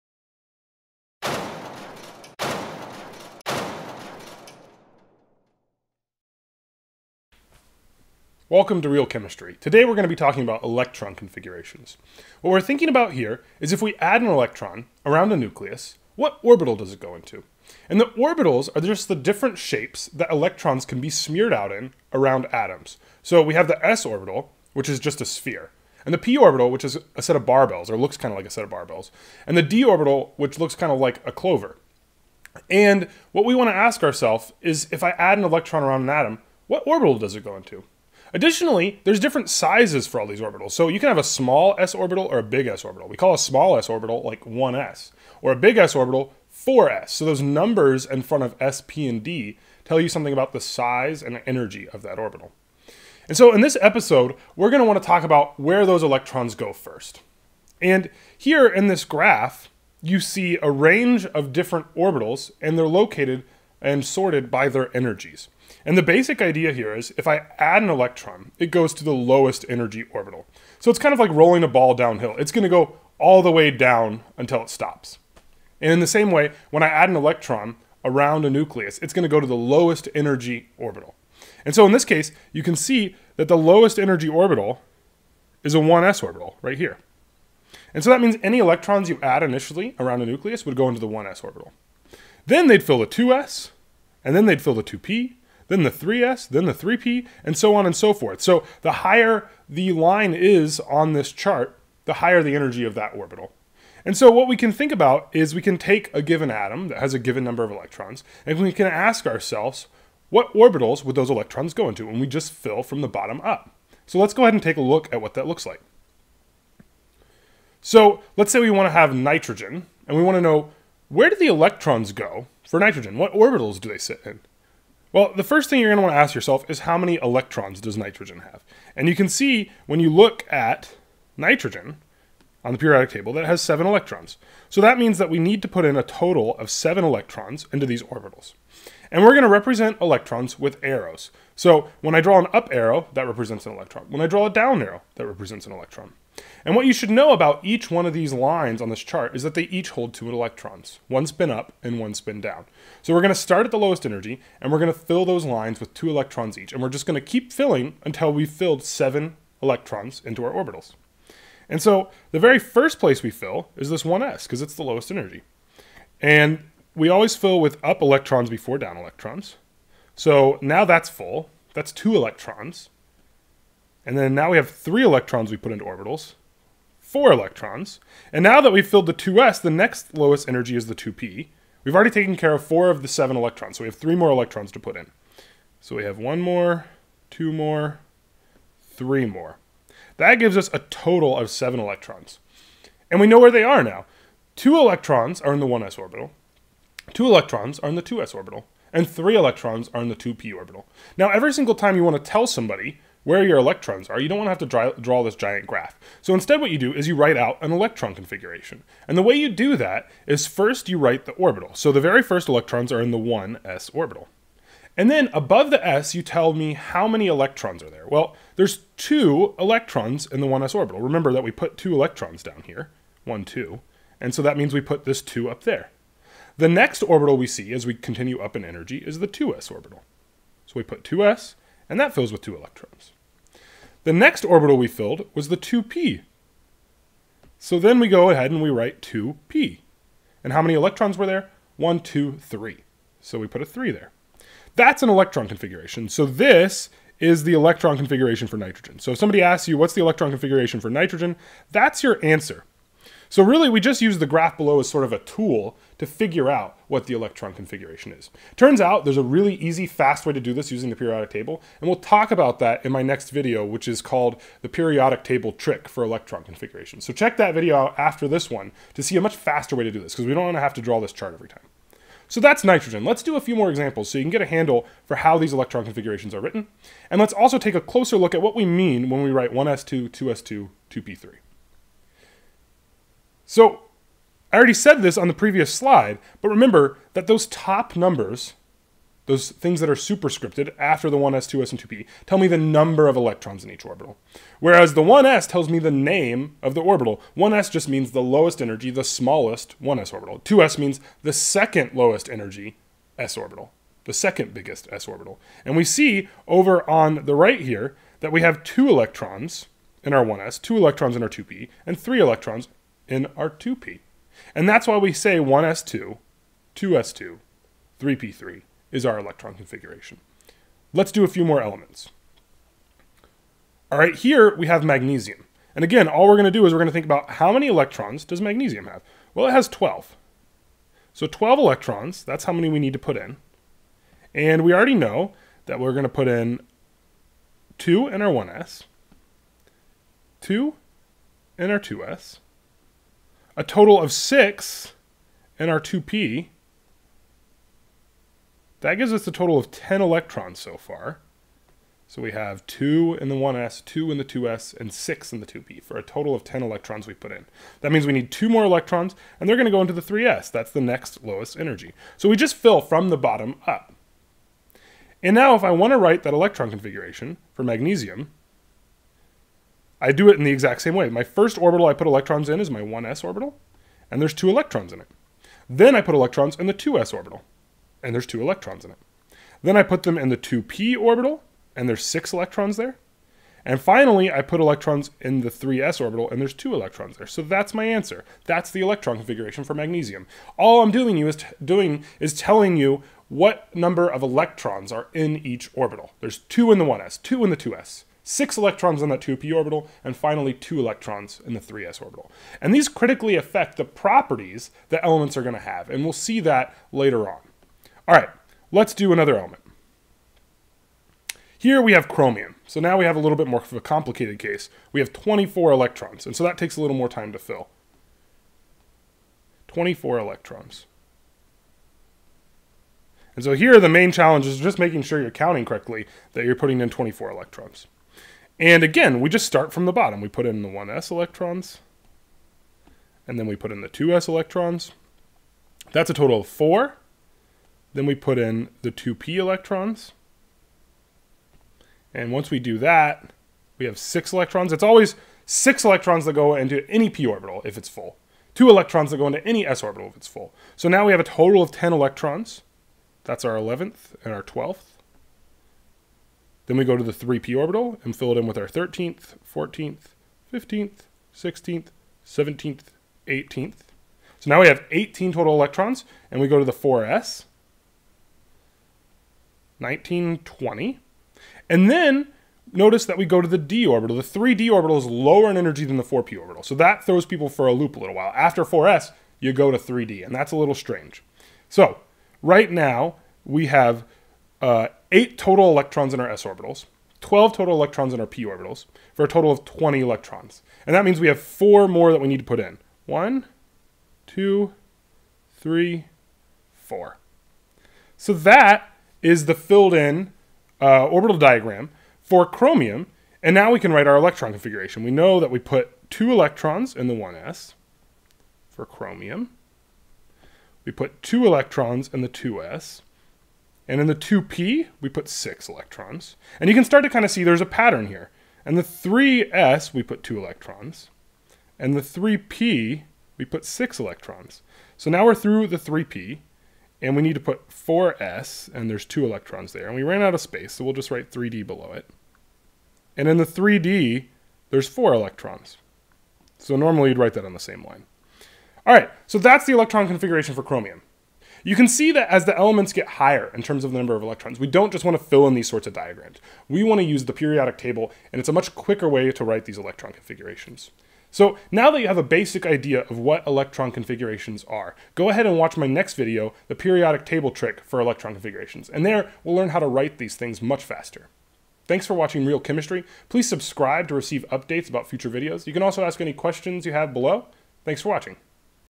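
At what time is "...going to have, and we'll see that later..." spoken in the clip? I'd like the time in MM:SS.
06:45.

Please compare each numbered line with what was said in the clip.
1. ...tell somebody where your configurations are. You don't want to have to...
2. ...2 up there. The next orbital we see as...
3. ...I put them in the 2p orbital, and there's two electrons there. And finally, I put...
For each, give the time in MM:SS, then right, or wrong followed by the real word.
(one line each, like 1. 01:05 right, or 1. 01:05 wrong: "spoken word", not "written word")
1. 03:22 wrong: "electrons", not "configurations"
2. 03:45 right
3. 06:19 wrong: "six", not "two".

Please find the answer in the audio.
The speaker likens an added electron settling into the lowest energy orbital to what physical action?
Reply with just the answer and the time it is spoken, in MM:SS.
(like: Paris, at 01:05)
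rolling a ball downhill, at 01:11.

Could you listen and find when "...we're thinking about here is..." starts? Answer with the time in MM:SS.
00:12.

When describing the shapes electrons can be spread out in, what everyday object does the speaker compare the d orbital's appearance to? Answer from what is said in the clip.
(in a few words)
a clover.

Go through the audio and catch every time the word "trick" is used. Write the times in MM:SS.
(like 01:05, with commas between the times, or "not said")
04:25, 09:17.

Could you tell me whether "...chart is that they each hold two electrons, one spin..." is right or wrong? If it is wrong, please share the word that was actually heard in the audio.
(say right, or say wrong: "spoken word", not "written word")
right.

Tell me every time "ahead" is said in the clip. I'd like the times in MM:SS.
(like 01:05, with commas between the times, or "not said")
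01:54, 03:58, 09:15.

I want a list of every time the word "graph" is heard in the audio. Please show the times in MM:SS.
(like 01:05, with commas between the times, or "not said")
00:59, 03:25, 04:14.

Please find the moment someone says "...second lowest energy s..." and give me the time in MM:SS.
05:01.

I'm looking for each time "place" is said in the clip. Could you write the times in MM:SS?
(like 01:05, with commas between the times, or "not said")
02:42.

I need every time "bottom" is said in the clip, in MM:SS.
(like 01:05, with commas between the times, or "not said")
01:53, 06:03, 07:09.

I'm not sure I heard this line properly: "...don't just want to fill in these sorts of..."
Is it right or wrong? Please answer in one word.
right.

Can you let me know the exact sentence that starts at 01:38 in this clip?
So the higher the line is on this chart, the higher the energy of that orbital.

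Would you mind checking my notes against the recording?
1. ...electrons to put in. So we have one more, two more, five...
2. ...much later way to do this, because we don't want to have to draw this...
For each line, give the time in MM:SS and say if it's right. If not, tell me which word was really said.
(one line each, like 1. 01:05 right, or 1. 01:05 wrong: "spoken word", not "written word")
1. 03:04 wrong: "three", not "five"
2. 04:29 wrong: "faster", not "later".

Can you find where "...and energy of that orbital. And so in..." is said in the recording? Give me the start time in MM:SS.
00:51.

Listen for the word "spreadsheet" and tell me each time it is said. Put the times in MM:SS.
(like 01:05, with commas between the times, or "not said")
not said.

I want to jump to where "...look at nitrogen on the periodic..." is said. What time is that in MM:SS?
02:10.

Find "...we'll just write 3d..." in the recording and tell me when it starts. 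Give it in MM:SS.
08:50.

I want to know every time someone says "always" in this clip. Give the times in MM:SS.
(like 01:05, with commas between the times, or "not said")
02:47, 07:24.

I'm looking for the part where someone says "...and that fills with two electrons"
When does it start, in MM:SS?
03:51.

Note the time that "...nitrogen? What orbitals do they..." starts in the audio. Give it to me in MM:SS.
02:02.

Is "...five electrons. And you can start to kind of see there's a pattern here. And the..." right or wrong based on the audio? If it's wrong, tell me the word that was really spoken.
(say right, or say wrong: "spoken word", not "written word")
wrong: "six", not "five".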